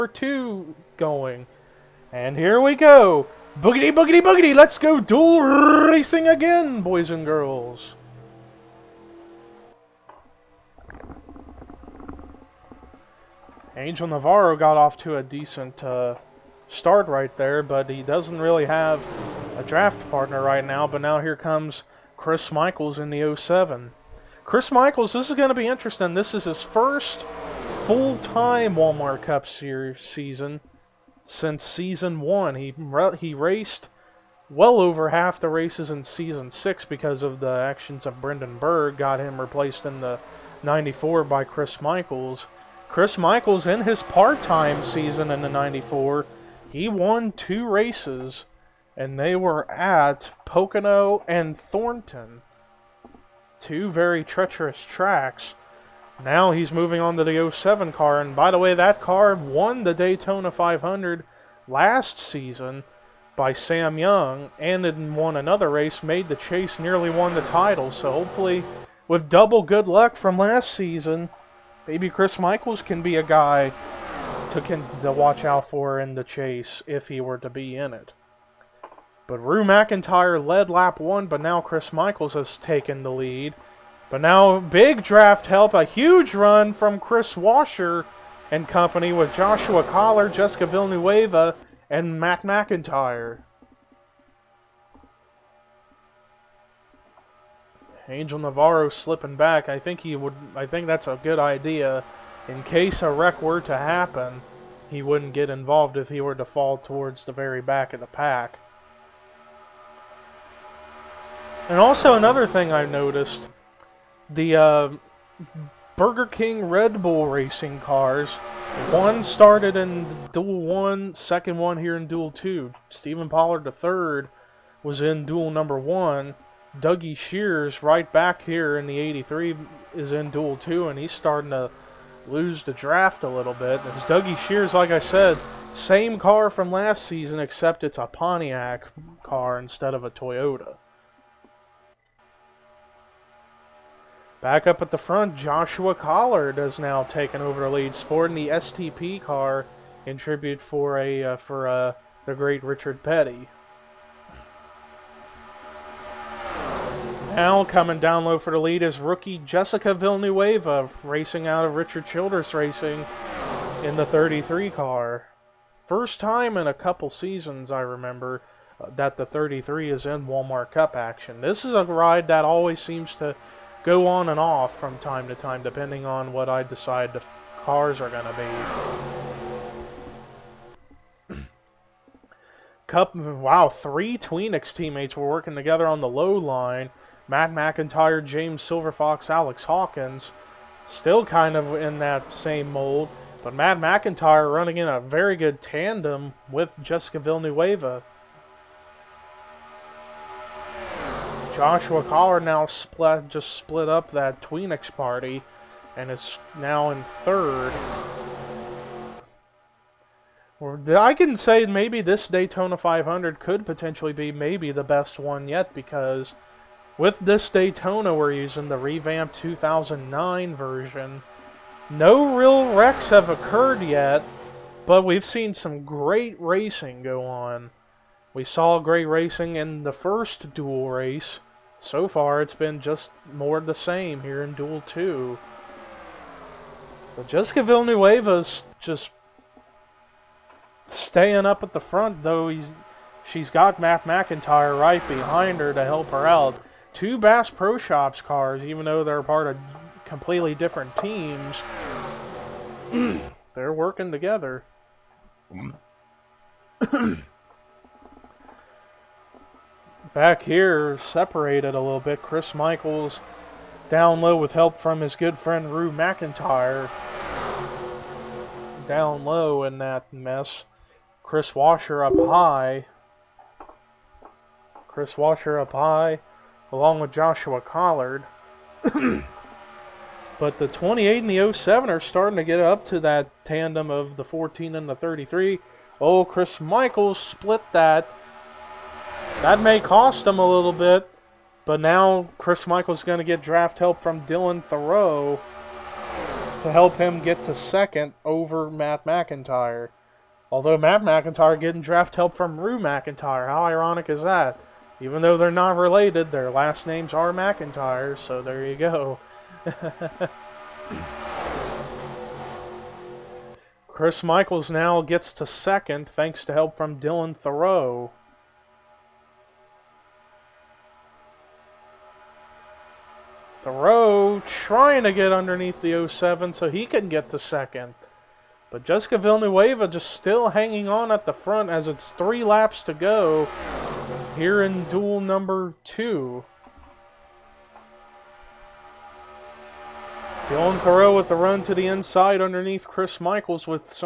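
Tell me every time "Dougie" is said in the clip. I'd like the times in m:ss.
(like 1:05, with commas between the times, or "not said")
2:06, 2:14.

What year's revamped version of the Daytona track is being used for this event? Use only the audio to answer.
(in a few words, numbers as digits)
2009.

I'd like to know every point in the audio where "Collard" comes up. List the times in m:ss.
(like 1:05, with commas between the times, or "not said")
1:29, 2:25, 3:22, 4:37.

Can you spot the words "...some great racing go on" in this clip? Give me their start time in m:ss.
3:45.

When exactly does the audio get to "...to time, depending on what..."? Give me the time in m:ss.
2:55.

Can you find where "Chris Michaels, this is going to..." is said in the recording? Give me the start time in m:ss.
0:24.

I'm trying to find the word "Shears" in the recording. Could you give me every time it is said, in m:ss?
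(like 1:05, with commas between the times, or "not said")
2:07, 2:14.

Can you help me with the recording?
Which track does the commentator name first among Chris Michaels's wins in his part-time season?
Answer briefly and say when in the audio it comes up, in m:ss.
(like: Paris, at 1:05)
Pocono, at 0:50.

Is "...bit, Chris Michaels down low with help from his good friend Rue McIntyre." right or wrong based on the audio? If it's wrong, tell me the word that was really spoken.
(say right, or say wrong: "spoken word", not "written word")
right.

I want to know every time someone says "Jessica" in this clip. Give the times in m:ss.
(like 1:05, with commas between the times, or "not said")
1:30, 2:39, 3:16, 3:57, 5:28.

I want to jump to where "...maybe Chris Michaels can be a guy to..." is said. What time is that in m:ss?
1:11.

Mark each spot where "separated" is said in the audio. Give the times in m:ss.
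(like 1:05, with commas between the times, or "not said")
4:20.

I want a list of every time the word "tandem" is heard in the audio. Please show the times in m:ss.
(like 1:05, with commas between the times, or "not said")
3:15, 4:43.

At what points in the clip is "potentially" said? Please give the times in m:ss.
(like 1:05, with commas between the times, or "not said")
3:33.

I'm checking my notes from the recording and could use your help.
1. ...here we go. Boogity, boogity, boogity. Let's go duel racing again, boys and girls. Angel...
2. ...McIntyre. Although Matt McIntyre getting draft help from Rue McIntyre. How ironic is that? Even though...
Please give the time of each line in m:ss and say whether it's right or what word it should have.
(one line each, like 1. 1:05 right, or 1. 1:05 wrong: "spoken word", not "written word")
1. 0:02 right
2. 4:59 right.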